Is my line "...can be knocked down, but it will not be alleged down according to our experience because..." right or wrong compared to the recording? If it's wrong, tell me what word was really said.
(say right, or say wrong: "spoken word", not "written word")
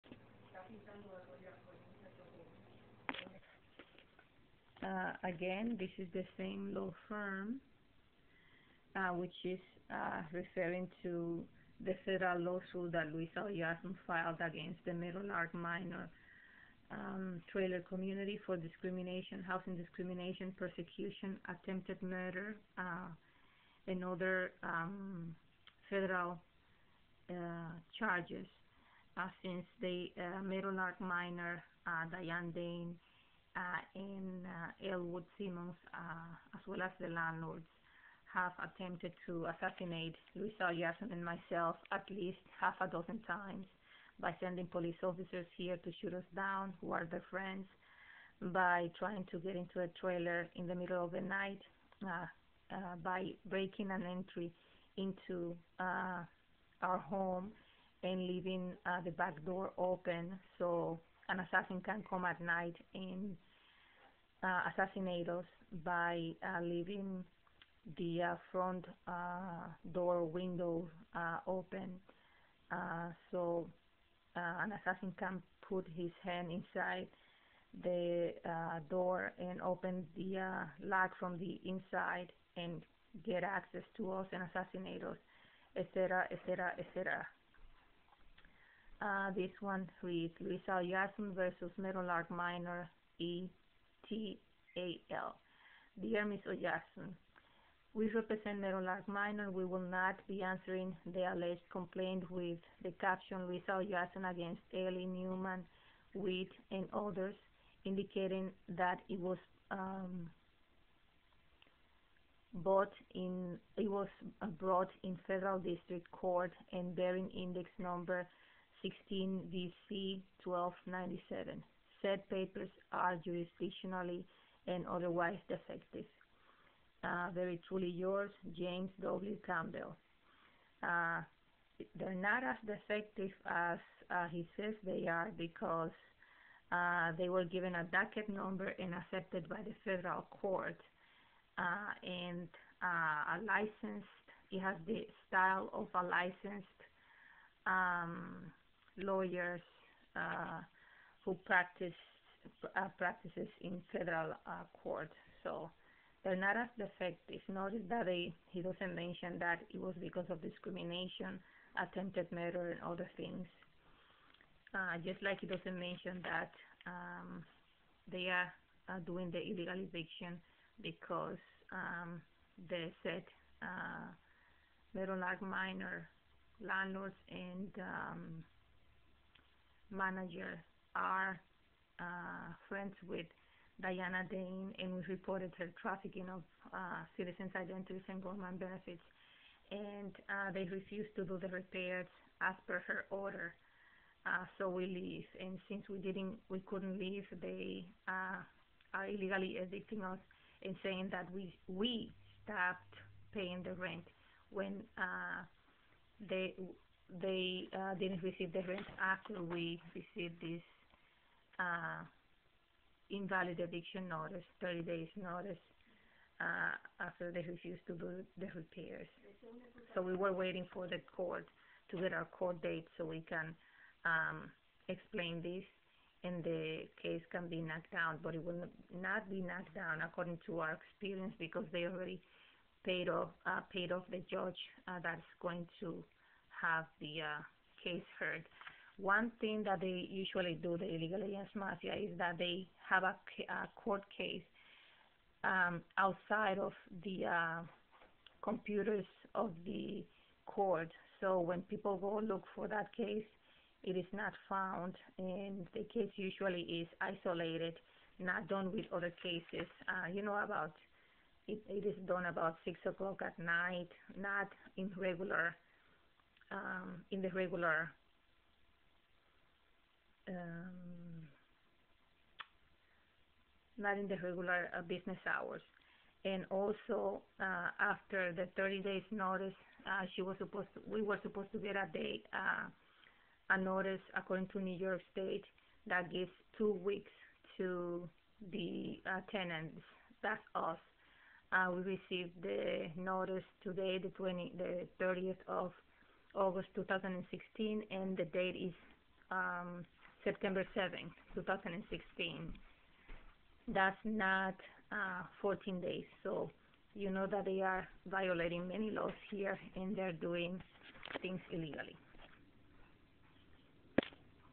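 wrong: "knocked", not "alleged".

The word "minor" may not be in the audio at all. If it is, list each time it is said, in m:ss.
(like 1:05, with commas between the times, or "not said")
0:15, 0:31, 1:32, 1:39, 2:55.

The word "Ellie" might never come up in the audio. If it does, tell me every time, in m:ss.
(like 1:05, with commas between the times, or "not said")
1:44.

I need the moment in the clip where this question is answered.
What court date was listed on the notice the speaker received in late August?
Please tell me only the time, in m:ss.
5:00.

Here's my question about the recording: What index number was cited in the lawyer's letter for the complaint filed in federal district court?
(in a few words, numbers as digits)
16 BC 1297.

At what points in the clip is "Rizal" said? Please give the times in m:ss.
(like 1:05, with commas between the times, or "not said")
1:30, 1:43.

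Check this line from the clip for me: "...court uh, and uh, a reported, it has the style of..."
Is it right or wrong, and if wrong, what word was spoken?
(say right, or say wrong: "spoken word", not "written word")
wrong: "licensed", not "reported".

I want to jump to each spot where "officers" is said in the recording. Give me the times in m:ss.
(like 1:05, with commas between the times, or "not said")
0:45.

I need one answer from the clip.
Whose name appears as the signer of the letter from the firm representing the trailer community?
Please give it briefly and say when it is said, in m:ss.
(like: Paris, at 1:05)
James W. Campbell, at 2:08.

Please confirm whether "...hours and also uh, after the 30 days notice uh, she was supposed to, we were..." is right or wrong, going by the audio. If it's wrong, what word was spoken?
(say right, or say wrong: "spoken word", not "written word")
right.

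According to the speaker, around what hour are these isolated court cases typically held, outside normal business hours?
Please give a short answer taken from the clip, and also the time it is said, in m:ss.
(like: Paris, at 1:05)
6 o'clock, at 4:22.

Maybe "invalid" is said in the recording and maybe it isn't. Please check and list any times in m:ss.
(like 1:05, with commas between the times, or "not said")
3:33.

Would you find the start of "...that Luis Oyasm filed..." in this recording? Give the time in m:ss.
0:12.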